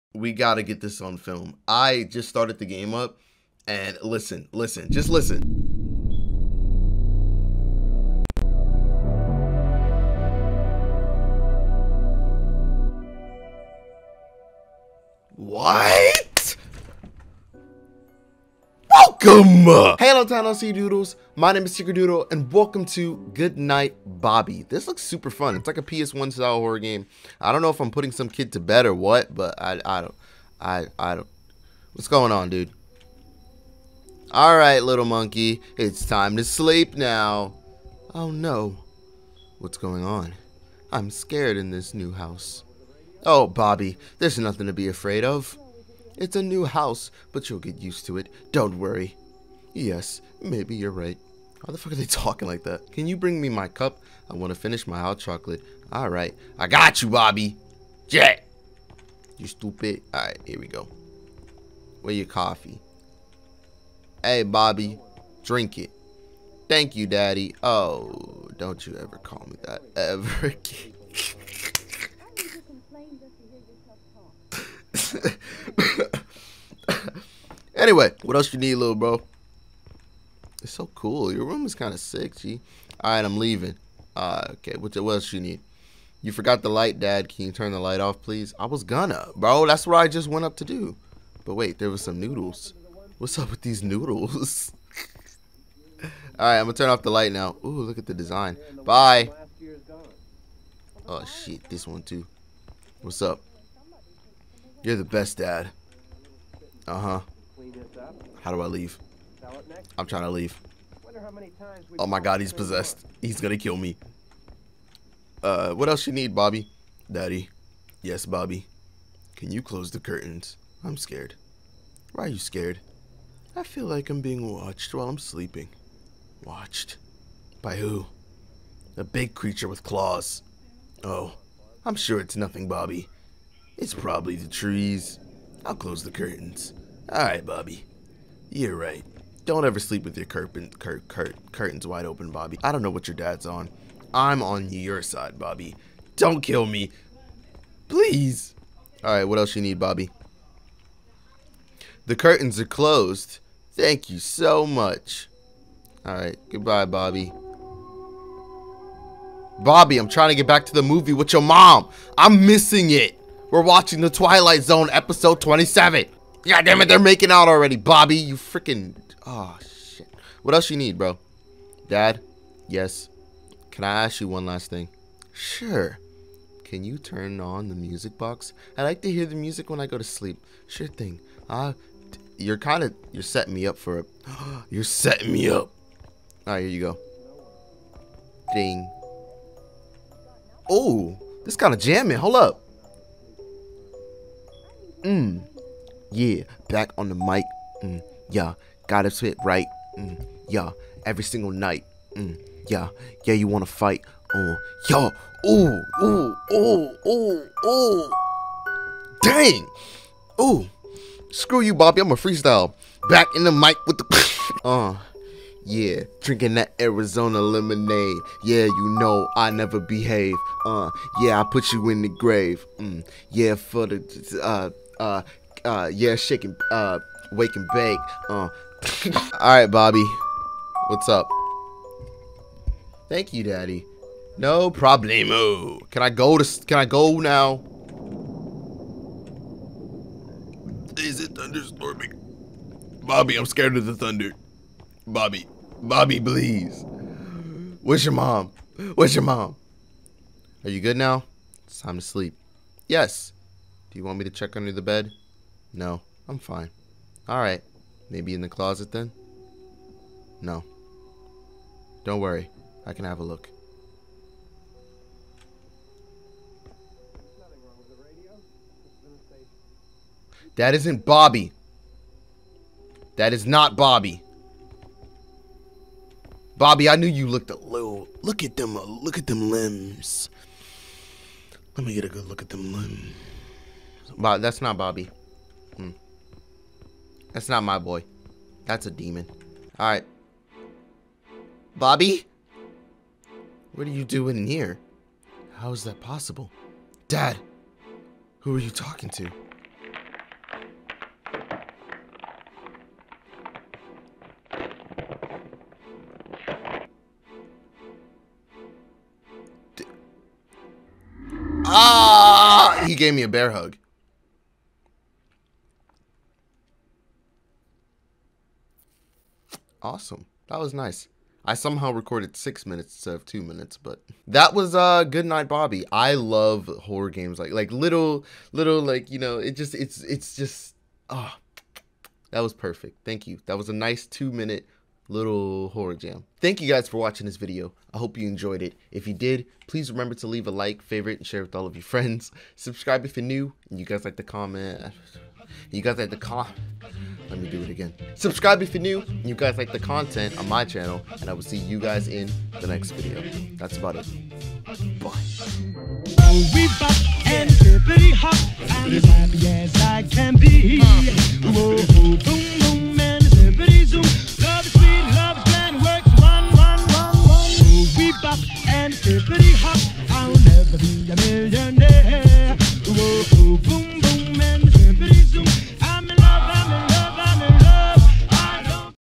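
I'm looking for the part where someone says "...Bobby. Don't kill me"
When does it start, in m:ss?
2:25.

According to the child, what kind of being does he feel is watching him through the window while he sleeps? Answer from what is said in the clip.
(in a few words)
A big creature with claws.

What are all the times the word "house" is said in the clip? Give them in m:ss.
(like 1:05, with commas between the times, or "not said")
0:42, 0:46.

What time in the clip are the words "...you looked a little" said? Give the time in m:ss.
4:37.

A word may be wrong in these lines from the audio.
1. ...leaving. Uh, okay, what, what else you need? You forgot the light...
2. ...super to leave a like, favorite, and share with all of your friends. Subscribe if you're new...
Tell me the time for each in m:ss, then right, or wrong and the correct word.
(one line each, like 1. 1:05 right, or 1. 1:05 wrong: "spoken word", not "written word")
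1. 1:23 right
2. 5:39 wrong: "remember", not "super".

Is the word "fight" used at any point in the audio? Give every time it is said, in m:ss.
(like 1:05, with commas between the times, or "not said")
3:23.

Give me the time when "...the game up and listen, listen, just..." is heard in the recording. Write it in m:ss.
0:02.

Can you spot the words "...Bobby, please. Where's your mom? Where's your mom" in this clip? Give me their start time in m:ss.
4:05.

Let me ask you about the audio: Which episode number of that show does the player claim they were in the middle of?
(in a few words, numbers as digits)
27.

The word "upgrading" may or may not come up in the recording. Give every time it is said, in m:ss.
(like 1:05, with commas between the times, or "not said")
not said.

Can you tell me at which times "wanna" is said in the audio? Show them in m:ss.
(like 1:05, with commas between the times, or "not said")
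3:23.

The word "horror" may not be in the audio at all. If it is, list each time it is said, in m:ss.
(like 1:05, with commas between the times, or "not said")
0:26, 5:26, 5:35.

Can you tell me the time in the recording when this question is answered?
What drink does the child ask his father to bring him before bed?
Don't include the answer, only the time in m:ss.
0:54.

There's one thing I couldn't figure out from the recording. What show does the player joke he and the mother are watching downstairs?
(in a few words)
The Twilight Zone.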